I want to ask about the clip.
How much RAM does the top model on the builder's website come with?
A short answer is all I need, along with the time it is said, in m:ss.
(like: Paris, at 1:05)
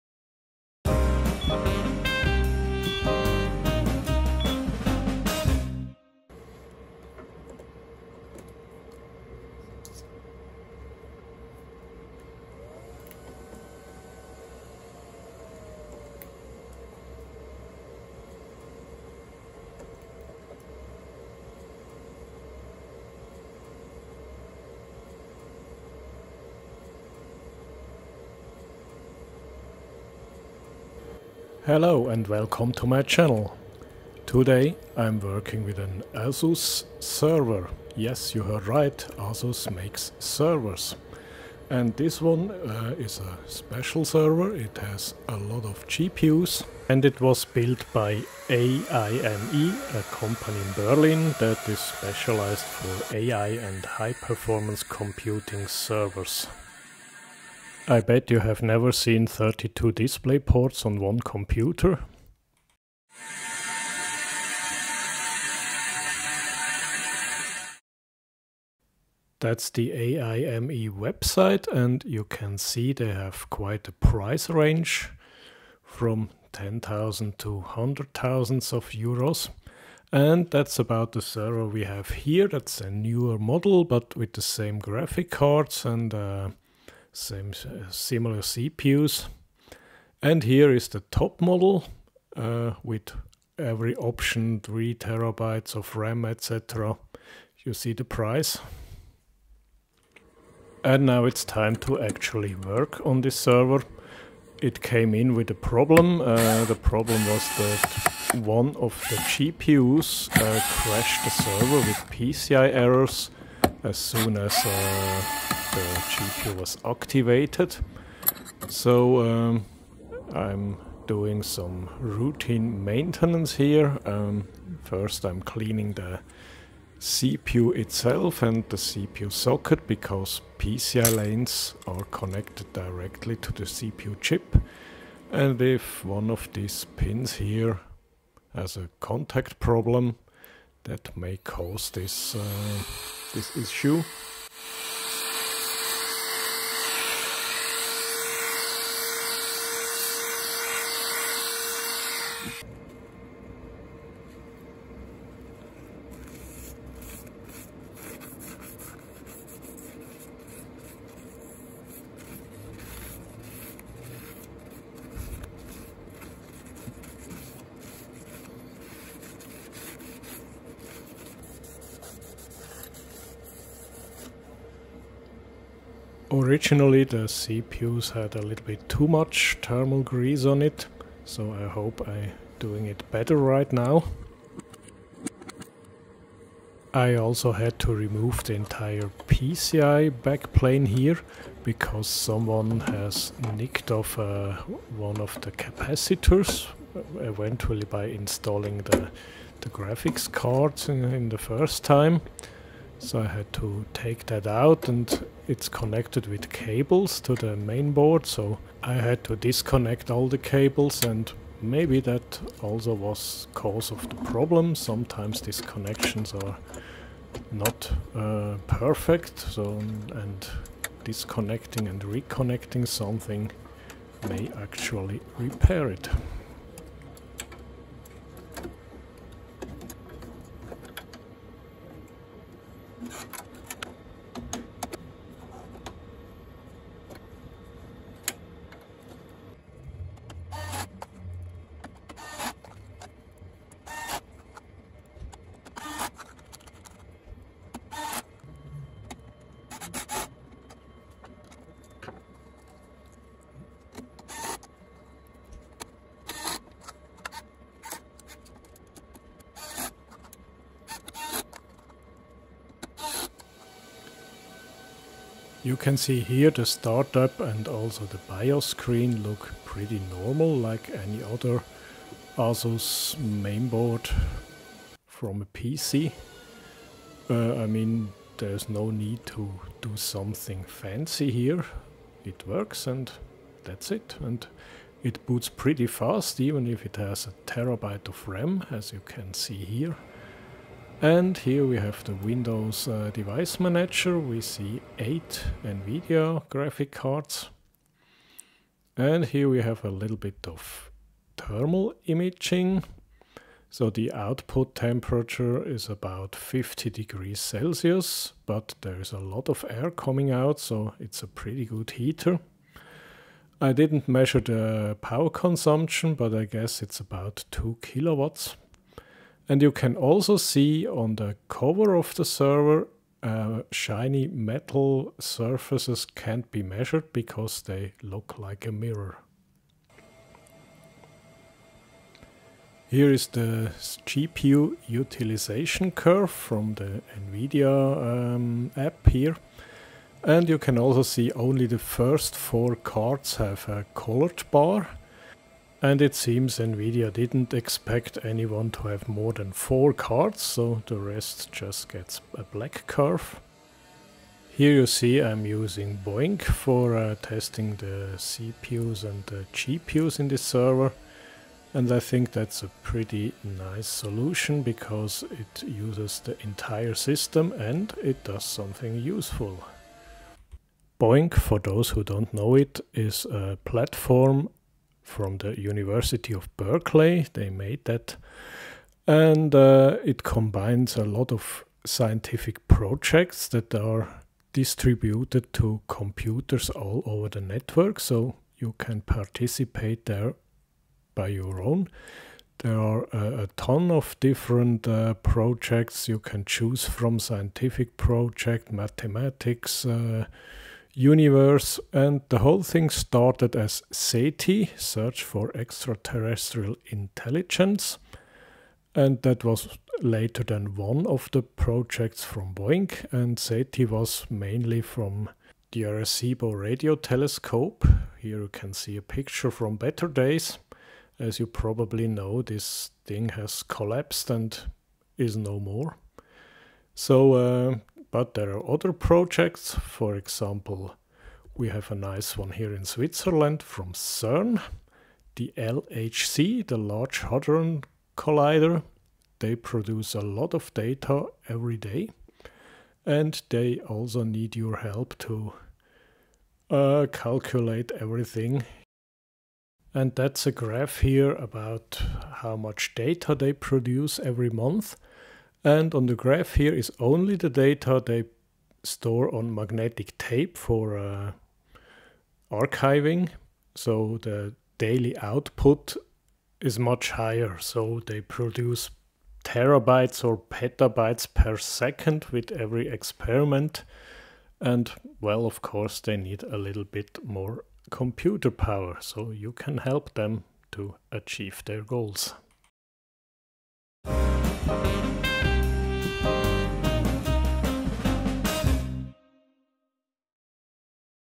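3 terabytes, at 1:34.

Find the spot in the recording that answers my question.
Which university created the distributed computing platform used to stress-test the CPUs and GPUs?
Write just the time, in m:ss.
6:15.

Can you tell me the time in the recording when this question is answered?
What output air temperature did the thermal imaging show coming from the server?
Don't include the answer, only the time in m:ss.
5:06.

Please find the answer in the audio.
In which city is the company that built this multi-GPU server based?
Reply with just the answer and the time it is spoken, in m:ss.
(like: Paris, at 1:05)
Berlin, at 0:50.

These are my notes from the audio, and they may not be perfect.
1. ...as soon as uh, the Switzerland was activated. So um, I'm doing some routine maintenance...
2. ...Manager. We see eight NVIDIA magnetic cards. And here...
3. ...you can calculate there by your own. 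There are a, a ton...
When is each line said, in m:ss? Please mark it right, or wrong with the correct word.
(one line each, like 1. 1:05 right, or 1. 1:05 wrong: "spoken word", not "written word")
1. 1:53 wrong: "GPU", not "Switzerland"
2. 4:53 wrong: "graphic", not "magnetic"
3. 6:28 wrong: "participate", not "calculate".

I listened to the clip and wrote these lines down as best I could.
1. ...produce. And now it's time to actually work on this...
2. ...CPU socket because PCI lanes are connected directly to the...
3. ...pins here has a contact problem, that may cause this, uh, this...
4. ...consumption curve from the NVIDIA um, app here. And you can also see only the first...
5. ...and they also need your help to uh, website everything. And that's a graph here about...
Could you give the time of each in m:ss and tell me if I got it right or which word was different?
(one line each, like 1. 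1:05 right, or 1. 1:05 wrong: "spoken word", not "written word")
1. 1:38 wrong: "price", not "produce"
2. 2:08 right
3. 2:16 right
4. 5:34 wrong: "utilization", not "consumption"
5. 7:23 wrong: "calculate", not "website".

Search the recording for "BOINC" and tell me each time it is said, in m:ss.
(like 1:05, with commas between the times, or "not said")
5:56, 6:10, 6:52.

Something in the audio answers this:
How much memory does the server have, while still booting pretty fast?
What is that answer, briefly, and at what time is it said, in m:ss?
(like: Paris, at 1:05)
a terabyte, at 4:47.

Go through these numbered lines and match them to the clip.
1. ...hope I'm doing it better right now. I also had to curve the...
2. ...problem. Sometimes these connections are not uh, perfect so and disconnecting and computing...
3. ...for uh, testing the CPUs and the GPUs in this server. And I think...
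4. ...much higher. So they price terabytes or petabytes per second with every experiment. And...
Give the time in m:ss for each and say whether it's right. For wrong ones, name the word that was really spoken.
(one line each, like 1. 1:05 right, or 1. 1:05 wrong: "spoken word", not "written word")
1. 3:01 wrong: "remove", not "curve"
2. 3:34 wrong: "reconnecting", not "computing"
3. 5:56 right
4. 7:46 wrong: "produce", not "price".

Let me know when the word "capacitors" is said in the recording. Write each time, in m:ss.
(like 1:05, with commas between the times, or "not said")
3:15.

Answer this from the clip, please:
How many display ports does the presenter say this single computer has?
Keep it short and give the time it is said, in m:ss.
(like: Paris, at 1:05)
32, at 0:59.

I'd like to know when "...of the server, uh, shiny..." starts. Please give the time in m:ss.
5:21.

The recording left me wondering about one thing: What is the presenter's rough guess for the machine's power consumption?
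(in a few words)
2 kilowatts.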